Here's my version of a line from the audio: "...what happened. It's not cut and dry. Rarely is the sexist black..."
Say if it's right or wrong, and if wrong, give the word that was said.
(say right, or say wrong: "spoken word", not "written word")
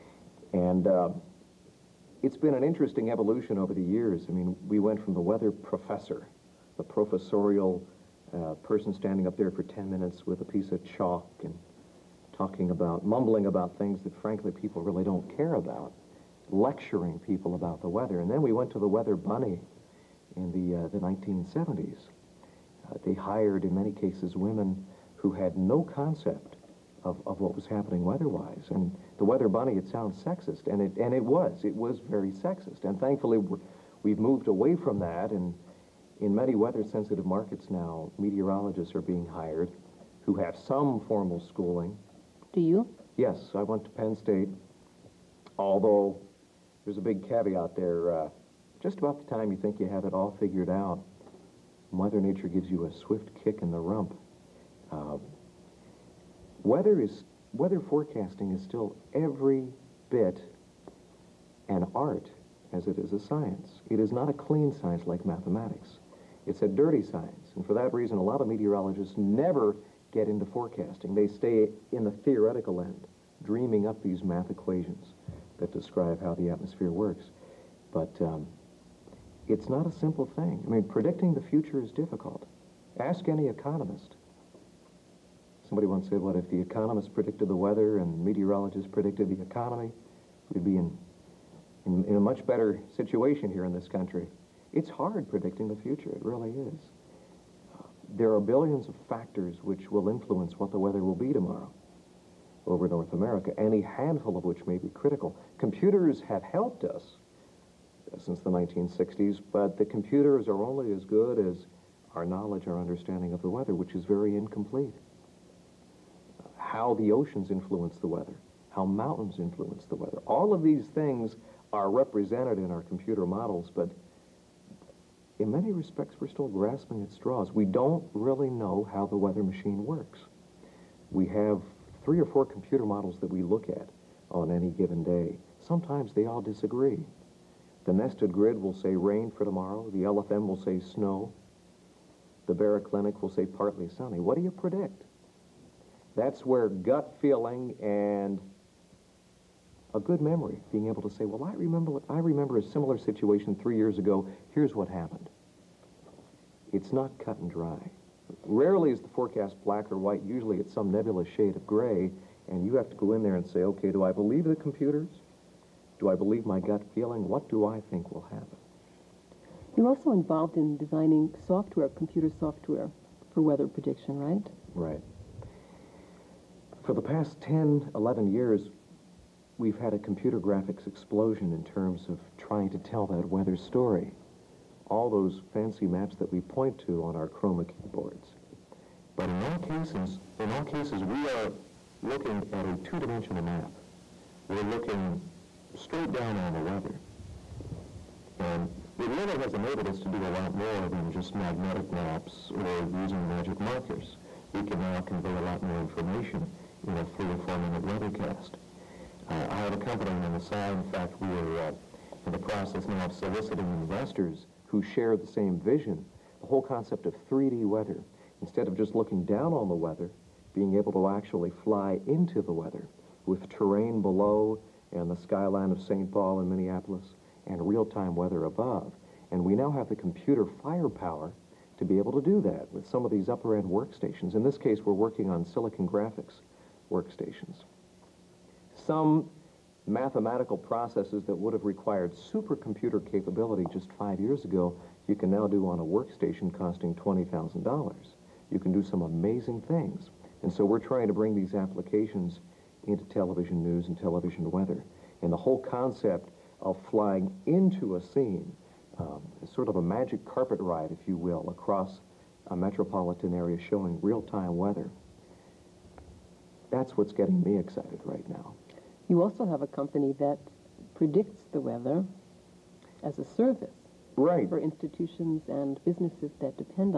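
wrong: "forecast", not "sexist".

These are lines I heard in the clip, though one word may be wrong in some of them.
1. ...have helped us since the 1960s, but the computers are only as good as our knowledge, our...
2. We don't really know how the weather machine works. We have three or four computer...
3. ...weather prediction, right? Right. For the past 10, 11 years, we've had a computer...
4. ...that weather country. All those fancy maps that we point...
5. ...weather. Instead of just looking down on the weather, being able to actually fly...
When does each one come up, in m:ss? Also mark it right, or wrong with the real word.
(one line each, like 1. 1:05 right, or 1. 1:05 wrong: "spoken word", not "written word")
1. 1:46 right
2. 2:07 right
3. 2:53 right
4. 3:03 wrong: "story", not "country"
5. 3:37 right.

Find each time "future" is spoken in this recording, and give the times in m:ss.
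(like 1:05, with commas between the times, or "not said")
1:21, 1:35.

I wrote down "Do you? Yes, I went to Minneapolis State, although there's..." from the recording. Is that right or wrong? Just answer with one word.
wrong.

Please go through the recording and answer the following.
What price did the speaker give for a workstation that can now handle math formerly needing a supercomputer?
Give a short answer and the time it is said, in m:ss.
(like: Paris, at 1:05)
$20,000, at 4:06.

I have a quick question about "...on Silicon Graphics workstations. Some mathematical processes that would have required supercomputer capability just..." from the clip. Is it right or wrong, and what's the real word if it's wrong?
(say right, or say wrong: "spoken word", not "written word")
right.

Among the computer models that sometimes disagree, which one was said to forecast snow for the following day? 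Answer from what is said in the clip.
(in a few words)
LFM.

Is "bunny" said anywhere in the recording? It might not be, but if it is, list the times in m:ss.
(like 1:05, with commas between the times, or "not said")
0:19, 0:29.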